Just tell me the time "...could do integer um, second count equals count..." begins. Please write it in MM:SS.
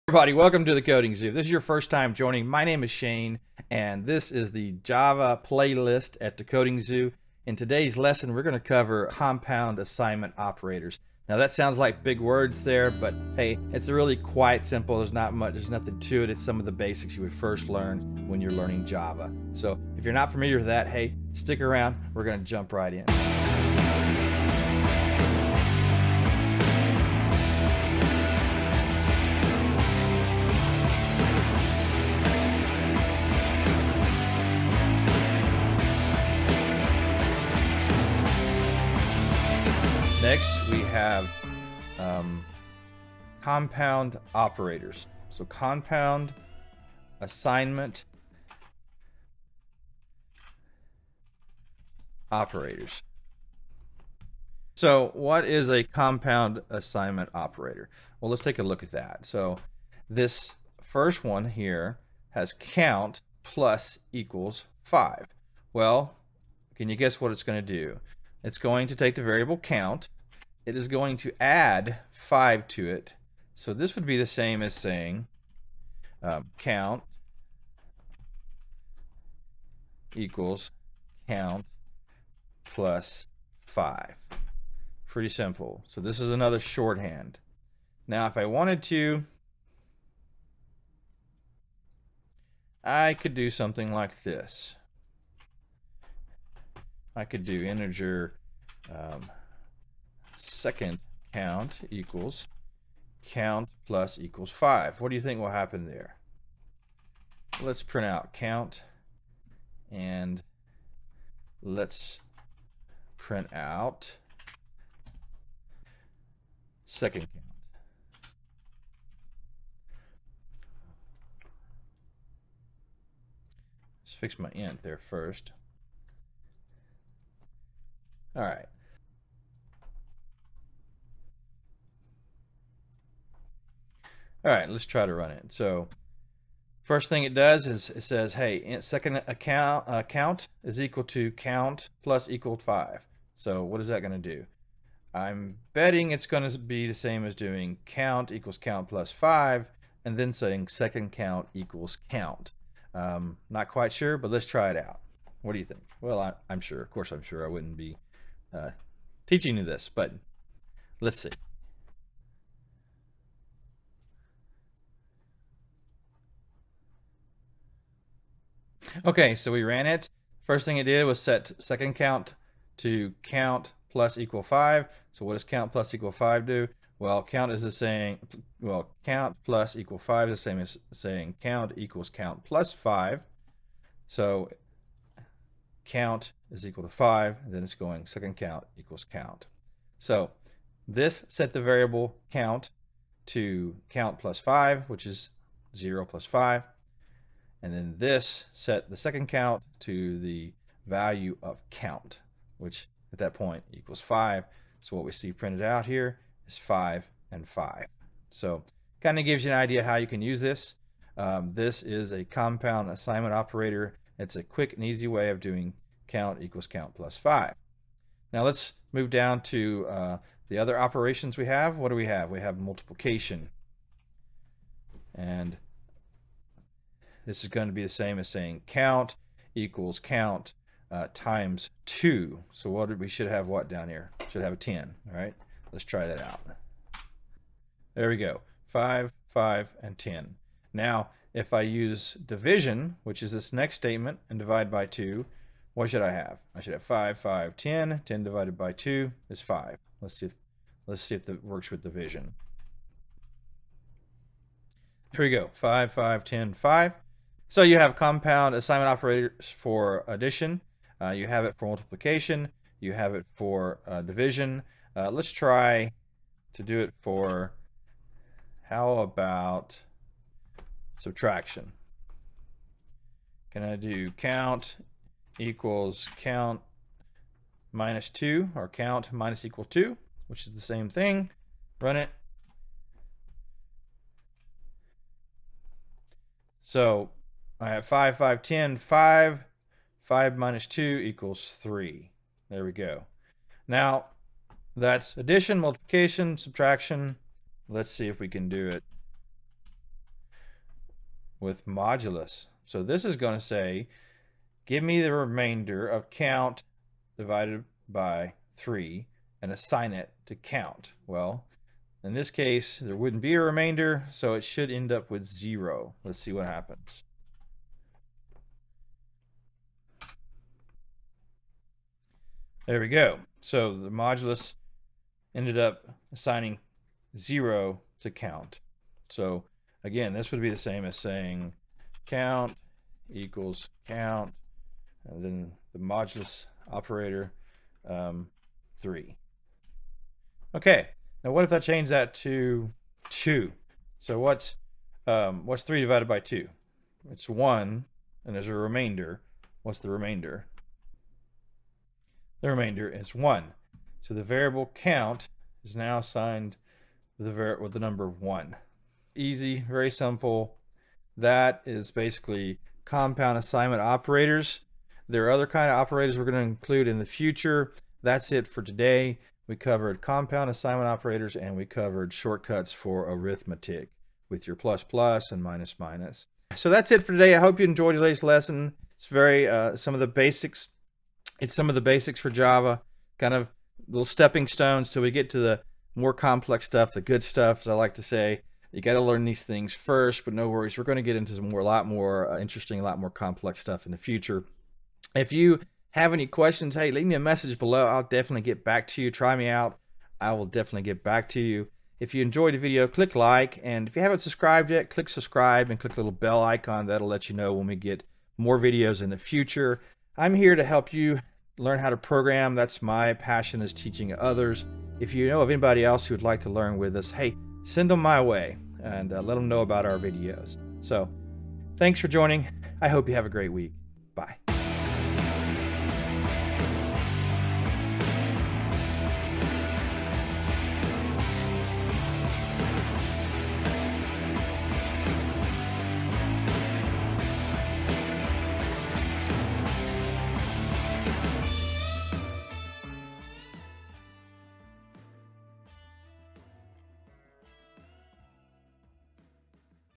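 01:37.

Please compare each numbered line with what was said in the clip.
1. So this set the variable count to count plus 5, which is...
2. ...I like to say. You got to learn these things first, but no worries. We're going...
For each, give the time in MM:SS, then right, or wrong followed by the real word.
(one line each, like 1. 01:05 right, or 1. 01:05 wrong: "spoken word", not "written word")
1. 03:09 right
2. 06:27 right.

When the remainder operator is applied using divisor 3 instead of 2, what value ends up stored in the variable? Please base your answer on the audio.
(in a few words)
0.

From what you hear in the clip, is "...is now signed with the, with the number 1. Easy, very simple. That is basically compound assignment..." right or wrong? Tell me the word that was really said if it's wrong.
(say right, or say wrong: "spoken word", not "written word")
right.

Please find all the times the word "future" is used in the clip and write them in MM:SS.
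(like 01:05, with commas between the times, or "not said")
06:07, 06:33, 06:49.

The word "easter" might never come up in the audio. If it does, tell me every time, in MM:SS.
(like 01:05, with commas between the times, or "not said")
not said.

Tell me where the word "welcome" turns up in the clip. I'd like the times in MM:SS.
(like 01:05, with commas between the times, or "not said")
00:00.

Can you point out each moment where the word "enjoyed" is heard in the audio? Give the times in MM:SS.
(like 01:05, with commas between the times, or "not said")
06:17, 06:42.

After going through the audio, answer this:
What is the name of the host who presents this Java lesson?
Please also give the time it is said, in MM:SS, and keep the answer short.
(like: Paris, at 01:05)
Shane, at 00:02.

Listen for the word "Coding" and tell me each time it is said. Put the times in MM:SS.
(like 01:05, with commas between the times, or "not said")
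00:00, 00:06.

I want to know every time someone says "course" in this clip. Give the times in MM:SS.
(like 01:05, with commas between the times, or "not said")
02:36.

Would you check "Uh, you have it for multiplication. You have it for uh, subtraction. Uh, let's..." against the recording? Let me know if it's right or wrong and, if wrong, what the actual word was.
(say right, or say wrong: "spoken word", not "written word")
wrong: "division", not "subtraction".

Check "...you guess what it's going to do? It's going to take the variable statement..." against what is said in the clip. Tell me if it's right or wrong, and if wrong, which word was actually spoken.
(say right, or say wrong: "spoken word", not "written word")
wrong: "count", not "statement".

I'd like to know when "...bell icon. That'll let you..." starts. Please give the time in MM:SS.
06:46.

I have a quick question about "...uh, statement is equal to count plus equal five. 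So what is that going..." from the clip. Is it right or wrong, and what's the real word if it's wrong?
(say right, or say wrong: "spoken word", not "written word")
wrong: "count", not "statement".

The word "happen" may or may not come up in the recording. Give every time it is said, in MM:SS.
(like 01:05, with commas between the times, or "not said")
01:45, 05:16.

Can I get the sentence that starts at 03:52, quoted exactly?
So what did, we should have what down here?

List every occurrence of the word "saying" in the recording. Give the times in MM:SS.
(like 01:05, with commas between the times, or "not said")
01:14, 02:30, 03:00, 03:48, 05:30.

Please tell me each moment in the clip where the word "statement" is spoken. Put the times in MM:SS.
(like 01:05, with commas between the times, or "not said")
04:03.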